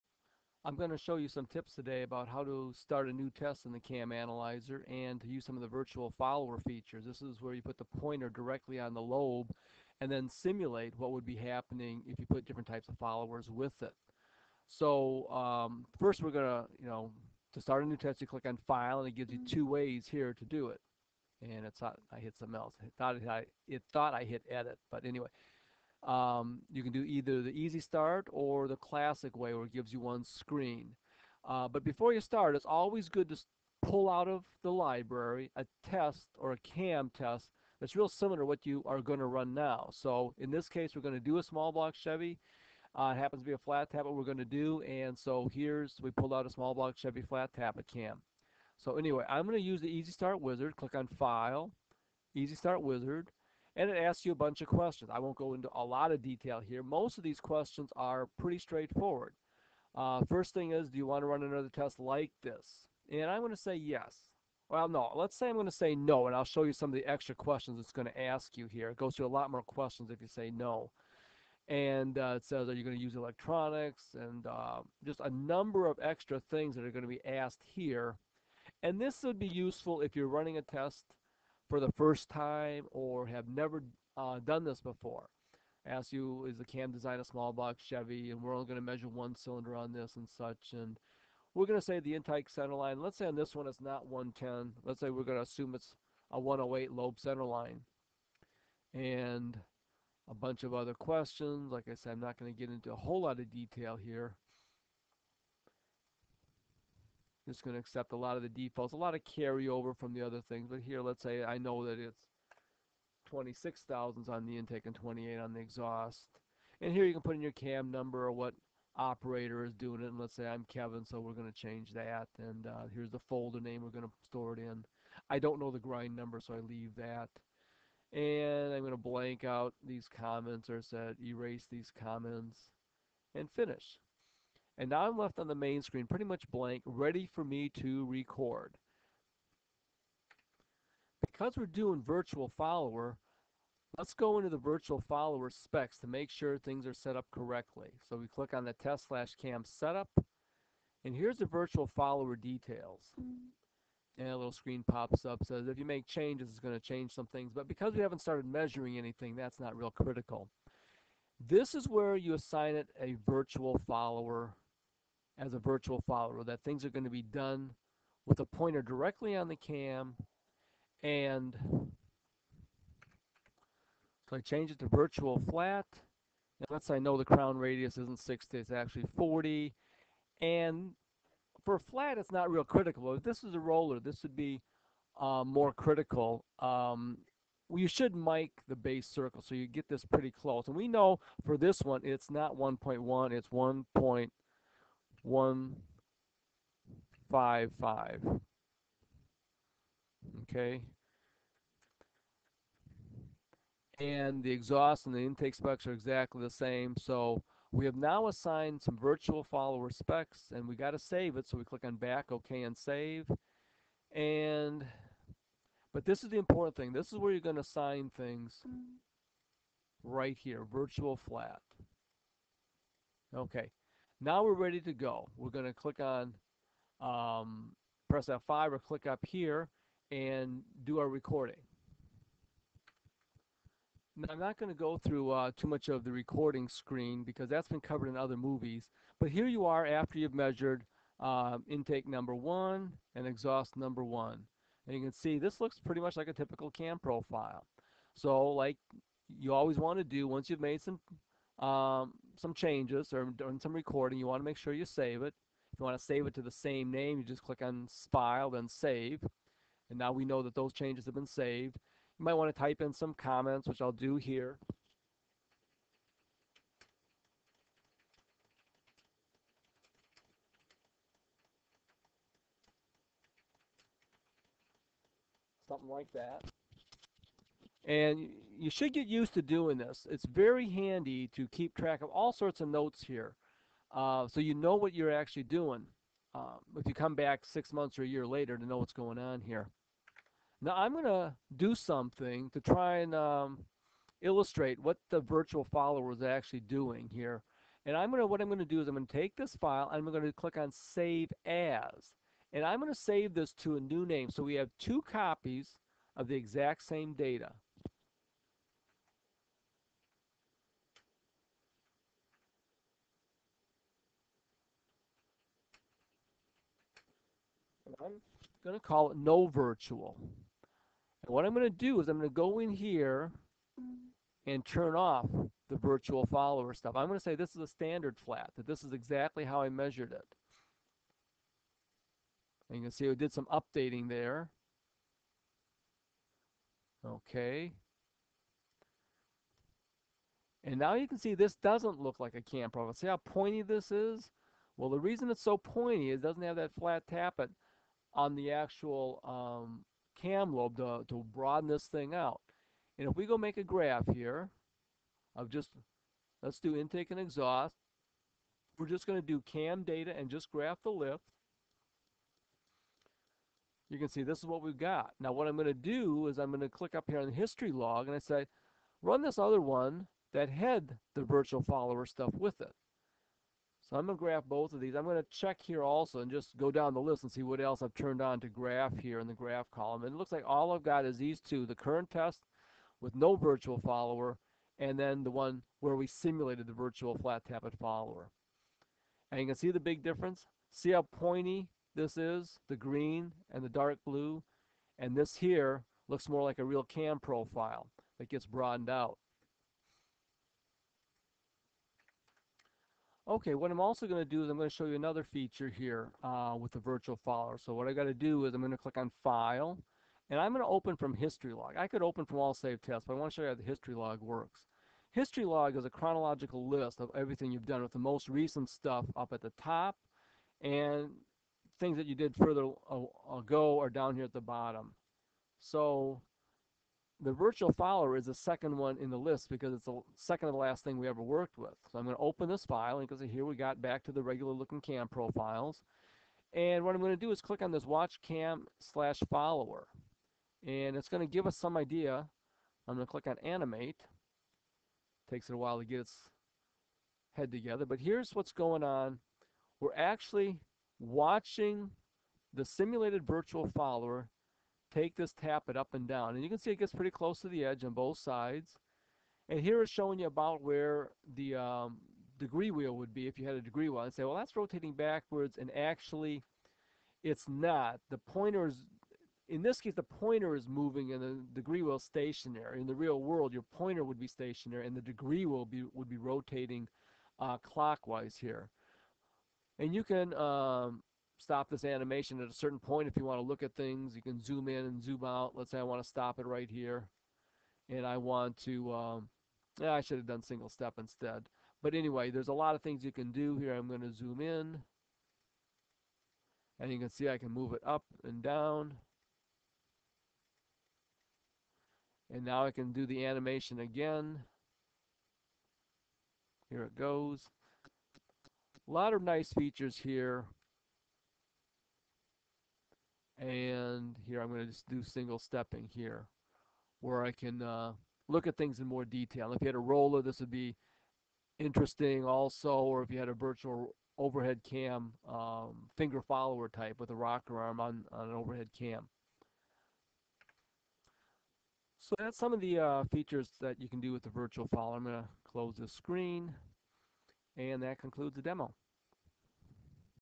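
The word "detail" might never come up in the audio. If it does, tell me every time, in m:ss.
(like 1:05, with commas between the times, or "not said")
0:56, 1:43, 2:32, 8:39.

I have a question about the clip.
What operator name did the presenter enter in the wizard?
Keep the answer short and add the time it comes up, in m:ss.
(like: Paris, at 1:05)
Kevin, at 2:00.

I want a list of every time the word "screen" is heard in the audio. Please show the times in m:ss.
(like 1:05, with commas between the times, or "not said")
0:30, 2:15, 2:34, 3:56, 8:55.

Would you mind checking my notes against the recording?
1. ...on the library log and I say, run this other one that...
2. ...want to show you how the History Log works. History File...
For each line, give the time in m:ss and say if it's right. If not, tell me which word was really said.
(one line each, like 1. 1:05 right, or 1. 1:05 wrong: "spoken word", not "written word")
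1. 6:07 wrong: "history", not "library"
2. 6:53 wrong: "Log", not "File".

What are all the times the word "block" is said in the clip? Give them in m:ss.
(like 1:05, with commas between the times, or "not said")
0:41, 0:46, 1:27.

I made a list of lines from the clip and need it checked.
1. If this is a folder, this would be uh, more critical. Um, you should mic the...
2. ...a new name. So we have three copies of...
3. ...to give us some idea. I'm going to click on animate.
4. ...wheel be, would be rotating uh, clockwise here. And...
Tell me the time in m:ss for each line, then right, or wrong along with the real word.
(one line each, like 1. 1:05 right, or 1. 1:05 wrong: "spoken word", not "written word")
1. 3:03 wrong: "roller", not "folder"
2. 5:03 wrong: "two", not "three"
3. 7:21 right
4. 7:55 right.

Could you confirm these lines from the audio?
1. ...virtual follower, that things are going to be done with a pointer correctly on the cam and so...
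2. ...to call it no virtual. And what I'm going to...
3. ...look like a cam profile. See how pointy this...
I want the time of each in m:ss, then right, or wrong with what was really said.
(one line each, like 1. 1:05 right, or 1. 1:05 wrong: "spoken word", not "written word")
1. 2:45 wrong: "directly", not "correctly"
2. 5:18 right
3. 5:41 right.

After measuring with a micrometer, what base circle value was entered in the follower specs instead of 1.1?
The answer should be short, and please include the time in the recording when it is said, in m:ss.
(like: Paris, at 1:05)
1.0155, at 3:13.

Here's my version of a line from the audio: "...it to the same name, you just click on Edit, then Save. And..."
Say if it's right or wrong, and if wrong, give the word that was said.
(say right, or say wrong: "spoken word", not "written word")
wrong: "File", not "Edit".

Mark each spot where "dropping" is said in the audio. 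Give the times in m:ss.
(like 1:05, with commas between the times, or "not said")
not said.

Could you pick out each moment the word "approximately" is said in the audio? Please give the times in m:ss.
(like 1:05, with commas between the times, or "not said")
not said.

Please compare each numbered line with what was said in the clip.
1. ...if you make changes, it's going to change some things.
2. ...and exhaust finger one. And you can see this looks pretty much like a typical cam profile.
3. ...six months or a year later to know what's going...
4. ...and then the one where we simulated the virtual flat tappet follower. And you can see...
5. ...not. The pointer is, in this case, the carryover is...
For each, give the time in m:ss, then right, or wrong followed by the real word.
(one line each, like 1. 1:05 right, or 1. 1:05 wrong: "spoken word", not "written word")
1. 2:35 right
2. 4:03 wrong: "number", not "finger"
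3. 4:47 right
4. 6:24 right
5. 7:47 wrong: "pointer", not "carryover".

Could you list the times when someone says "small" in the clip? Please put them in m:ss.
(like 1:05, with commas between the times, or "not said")
0:41, 0:46, 1:27.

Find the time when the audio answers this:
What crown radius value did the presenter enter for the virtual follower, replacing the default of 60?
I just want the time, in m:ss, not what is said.
2:59.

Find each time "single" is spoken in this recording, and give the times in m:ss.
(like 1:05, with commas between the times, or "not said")
8:10, 8:35.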